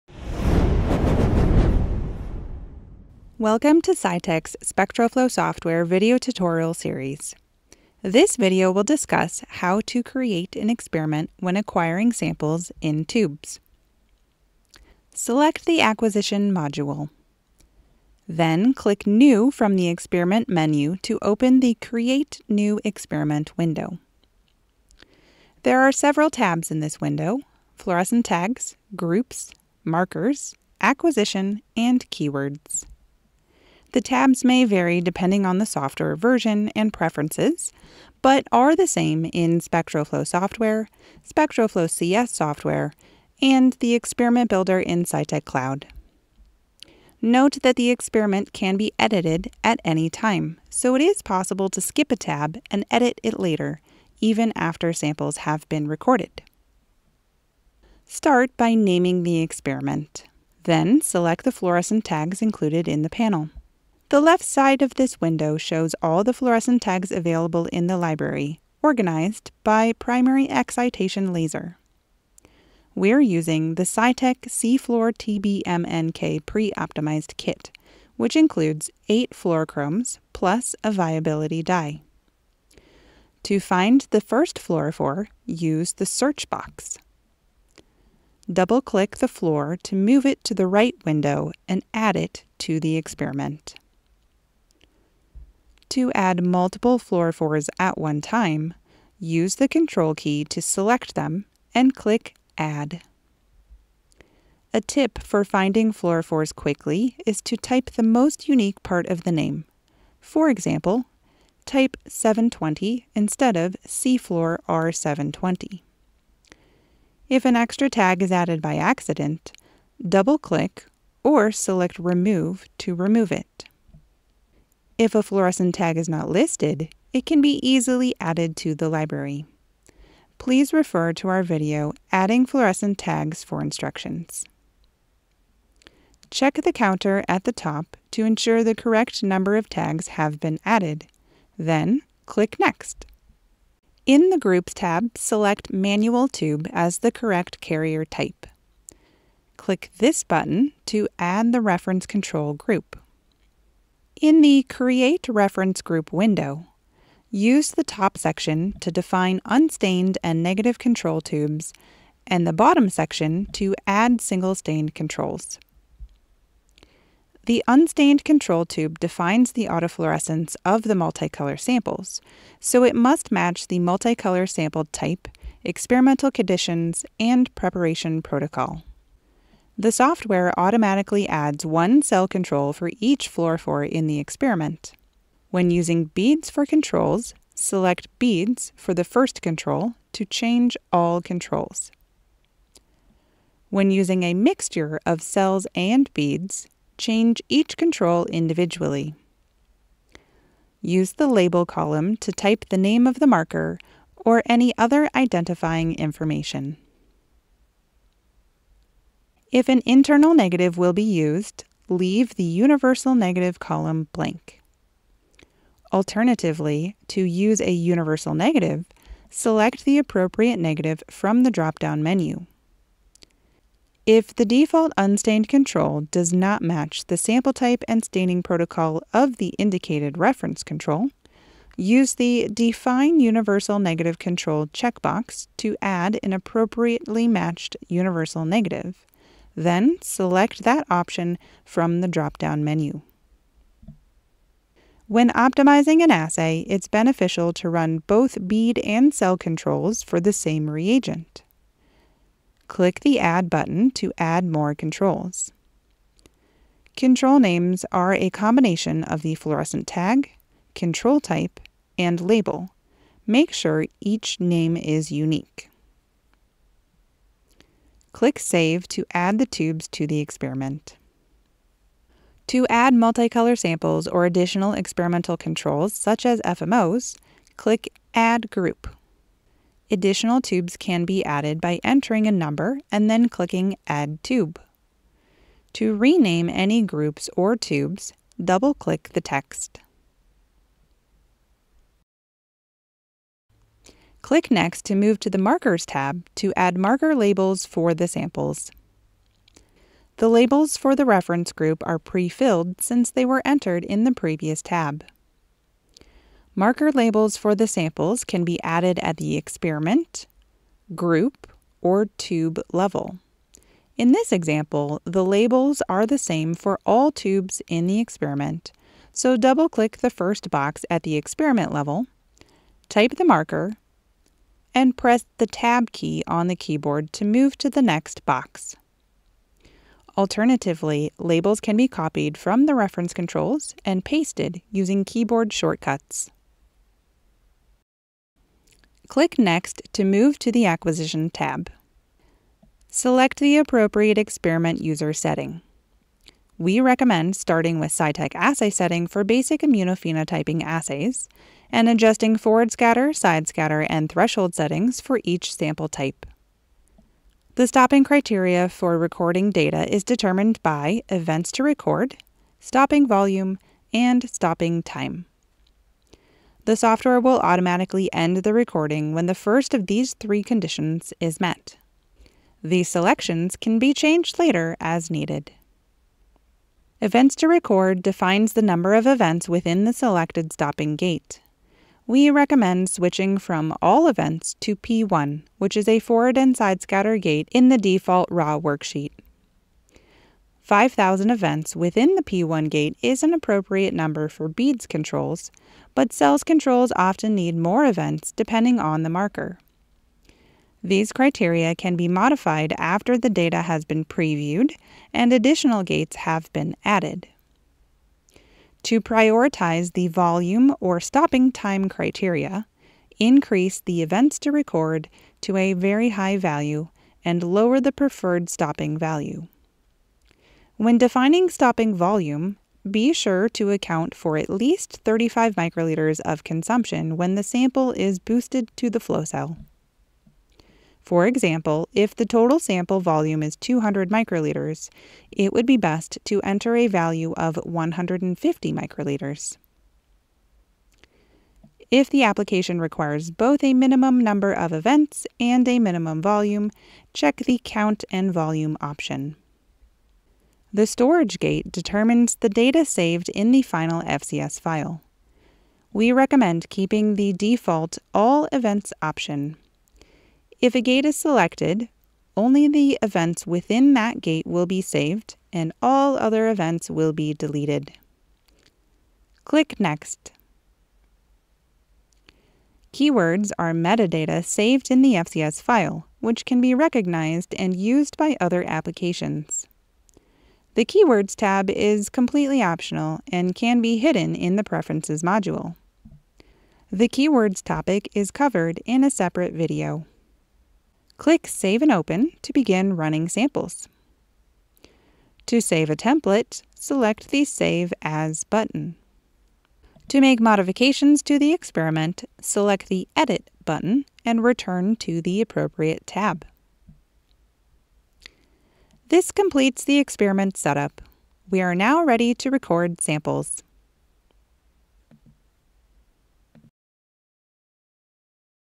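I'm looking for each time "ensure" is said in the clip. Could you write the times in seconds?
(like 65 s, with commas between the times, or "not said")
138 s.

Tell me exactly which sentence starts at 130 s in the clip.
Please refer to our video, Adding Fluorescent Tags for instructions.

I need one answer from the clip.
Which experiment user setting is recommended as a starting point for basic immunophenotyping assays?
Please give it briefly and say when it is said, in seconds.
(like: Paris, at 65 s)
Cytek assay setting, at 347 s.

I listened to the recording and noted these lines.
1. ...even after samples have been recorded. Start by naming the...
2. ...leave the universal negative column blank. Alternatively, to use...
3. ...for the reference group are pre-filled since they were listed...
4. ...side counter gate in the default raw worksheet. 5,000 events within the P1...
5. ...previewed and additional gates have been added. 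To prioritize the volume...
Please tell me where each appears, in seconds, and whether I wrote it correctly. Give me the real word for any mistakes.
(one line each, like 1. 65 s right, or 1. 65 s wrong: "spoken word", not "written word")
1. 54 s right
2. 211 s right
3. 300 s wrong: "entered", not "listed"
4. 386 s wrong: "scatter", not "counter"
5. 404 s right.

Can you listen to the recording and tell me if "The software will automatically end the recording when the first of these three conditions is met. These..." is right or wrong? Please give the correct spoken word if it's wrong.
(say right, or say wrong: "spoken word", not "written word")
right.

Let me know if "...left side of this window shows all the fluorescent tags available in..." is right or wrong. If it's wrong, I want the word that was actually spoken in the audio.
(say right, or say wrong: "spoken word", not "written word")
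right.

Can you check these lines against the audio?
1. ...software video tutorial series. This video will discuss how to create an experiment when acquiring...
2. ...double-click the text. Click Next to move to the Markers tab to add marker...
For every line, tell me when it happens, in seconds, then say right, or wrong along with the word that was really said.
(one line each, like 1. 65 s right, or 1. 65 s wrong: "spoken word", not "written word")
1. 5 s right
2. 288 s right.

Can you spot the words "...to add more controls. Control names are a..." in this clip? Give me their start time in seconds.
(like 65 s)
253 s.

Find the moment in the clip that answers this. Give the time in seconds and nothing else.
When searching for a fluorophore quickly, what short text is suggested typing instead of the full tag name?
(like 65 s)
112 s.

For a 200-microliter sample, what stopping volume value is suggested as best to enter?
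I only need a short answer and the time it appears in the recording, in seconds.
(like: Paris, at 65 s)
150 microliters, at 437 s.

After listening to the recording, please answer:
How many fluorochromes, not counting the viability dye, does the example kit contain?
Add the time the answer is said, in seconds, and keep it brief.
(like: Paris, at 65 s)
8, at 79 s.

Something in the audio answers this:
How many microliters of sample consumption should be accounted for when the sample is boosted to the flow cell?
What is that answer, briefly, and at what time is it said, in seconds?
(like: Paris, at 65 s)
35, at 425 s.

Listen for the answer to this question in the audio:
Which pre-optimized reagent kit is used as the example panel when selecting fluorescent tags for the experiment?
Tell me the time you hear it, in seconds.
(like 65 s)
73 s.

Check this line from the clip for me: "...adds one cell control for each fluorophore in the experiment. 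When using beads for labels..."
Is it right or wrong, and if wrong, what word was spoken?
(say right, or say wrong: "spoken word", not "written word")
wrong: "controls", not "labels".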